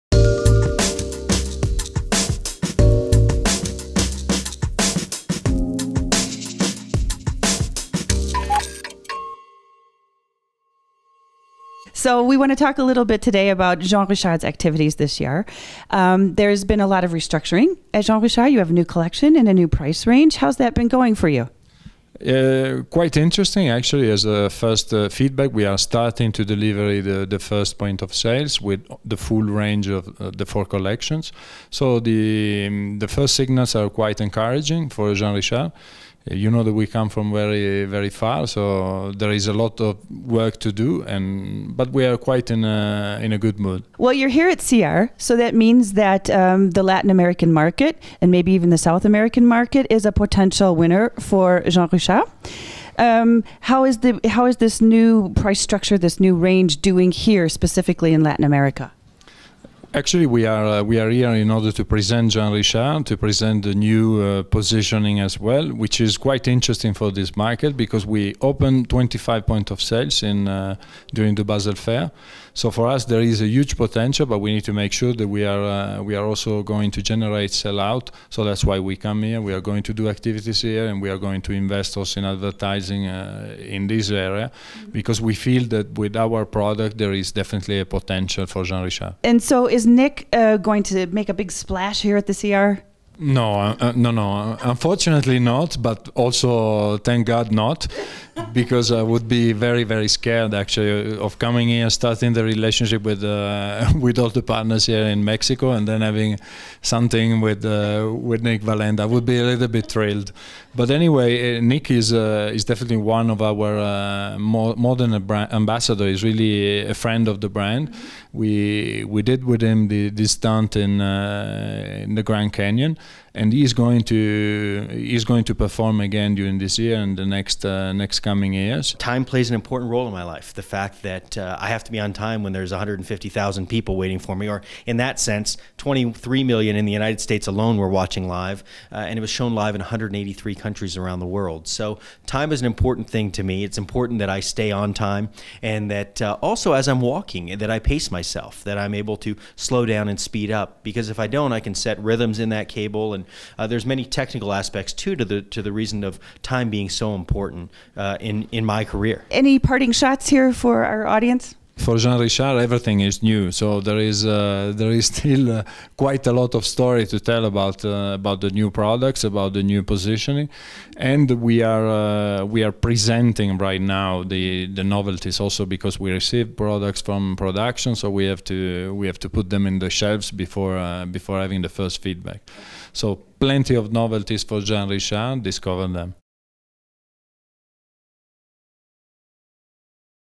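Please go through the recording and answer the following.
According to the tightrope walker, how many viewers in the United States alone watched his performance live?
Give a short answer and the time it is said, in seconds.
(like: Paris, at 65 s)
23 million, at 135 s.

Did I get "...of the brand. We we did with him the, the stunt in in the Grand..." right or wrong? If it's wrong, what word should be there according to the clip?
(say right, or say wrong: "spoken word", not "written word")
right.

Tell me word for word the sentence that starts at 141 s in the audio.
So time is an important thing to me.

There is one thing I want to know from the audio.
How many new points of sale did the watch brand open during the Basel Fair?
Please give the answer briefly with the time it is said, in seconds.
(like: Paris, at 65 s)
25, at 68 s.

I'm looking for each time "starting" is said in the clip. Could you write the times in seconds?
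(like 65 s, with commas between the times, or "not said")
25 s, 101 s.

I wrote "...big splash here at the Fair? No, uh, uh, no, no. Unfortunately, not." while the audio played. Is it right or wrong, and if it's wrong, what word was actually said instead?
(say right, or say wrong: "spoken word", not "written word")
wrong: "SIAR", not "Fair".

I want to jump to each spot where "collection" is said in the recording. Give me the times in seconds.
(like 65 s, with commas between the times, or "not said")
18 s, 30 s.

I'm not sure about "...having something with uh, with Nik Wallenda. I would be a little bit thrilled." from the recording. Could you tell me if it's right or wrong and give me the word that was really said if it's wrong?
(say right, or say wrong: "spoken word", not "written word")
right.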